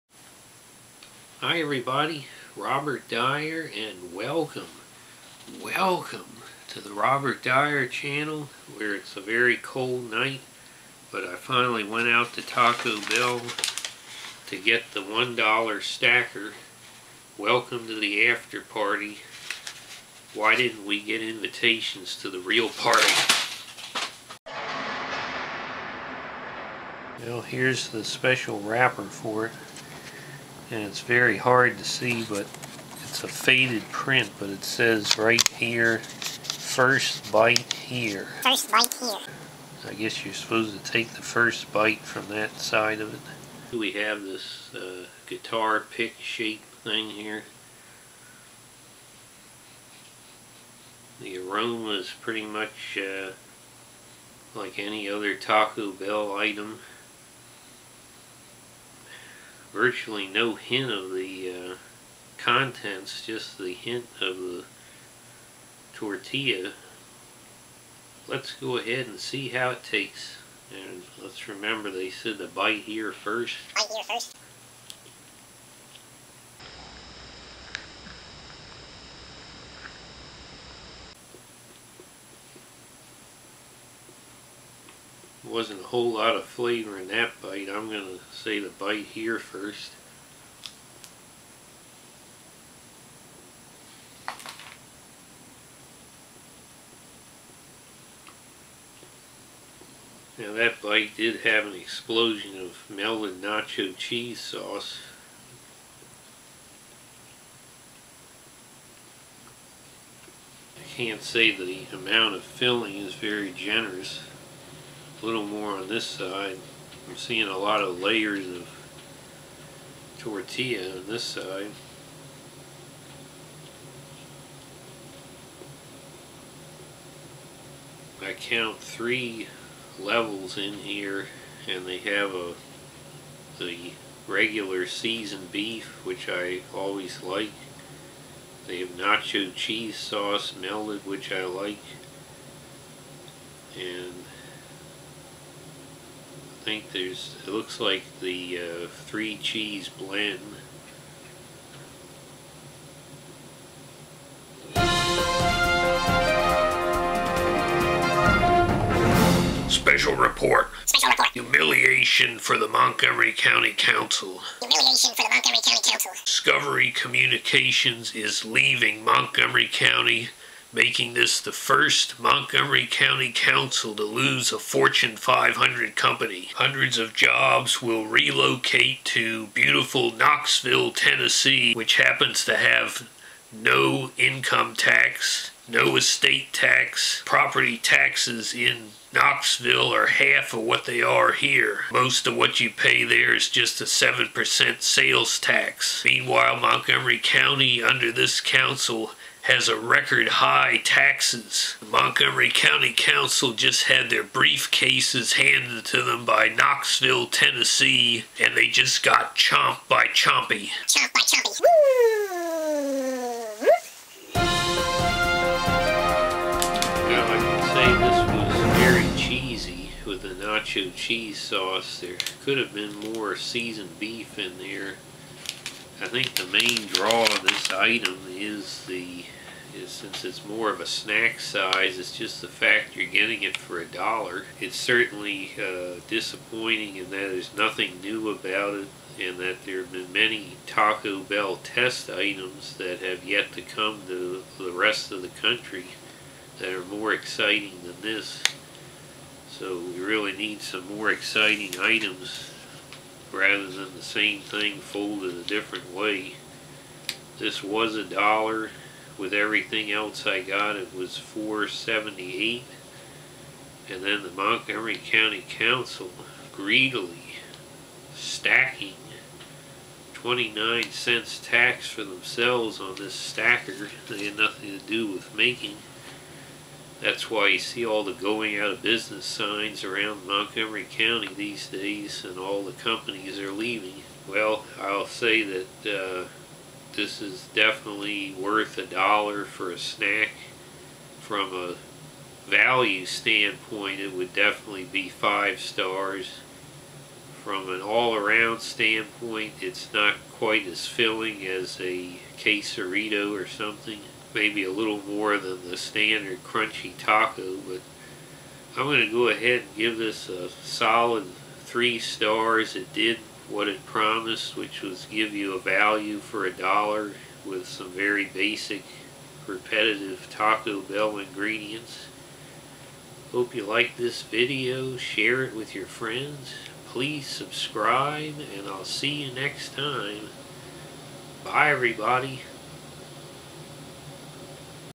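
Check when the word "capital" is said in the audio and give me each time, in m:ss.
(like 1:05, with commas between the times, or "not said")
not said.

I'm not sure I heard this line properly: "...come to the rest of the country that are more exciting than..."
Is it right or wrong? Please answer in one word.
right.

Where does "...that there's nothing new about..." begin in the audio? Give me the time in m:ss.
3:57.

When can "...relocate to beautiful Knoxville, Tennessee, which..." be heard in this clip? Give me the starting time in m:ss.
2:58.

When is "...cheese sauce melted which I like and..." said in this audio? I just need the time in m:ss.
2:19.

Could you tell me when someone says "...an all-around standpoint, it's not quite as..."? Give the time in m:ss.
4:57.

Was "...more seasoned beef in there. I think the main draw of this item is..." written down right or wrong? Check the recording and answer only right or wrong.
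right.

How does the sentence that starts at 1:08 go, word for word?
Let's go ahead and see how it tastes.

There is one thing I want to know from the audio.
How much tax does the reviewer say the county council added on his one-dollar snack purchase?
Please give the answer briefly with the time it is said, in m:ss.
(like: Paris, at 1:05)
29 cents, at 4:30.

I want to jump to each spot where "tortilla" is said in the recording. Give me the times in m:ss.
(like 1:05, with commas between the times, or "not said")
1:05, 2:00.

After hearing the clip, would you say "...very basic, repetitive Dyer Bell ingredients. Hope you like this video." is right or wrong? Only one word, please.
wrong.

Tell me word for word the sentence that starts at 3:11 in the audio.
Most of what you pay there is just a 7% sales tax.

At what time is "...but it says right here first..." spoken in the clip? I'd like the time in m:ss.
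0:34.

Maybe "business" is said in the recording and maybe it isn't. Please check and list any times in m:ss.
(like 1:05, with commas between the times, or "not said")
4:38.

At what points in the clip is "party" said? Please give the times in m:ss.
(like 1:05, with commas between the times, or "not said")
0:18, 0:22.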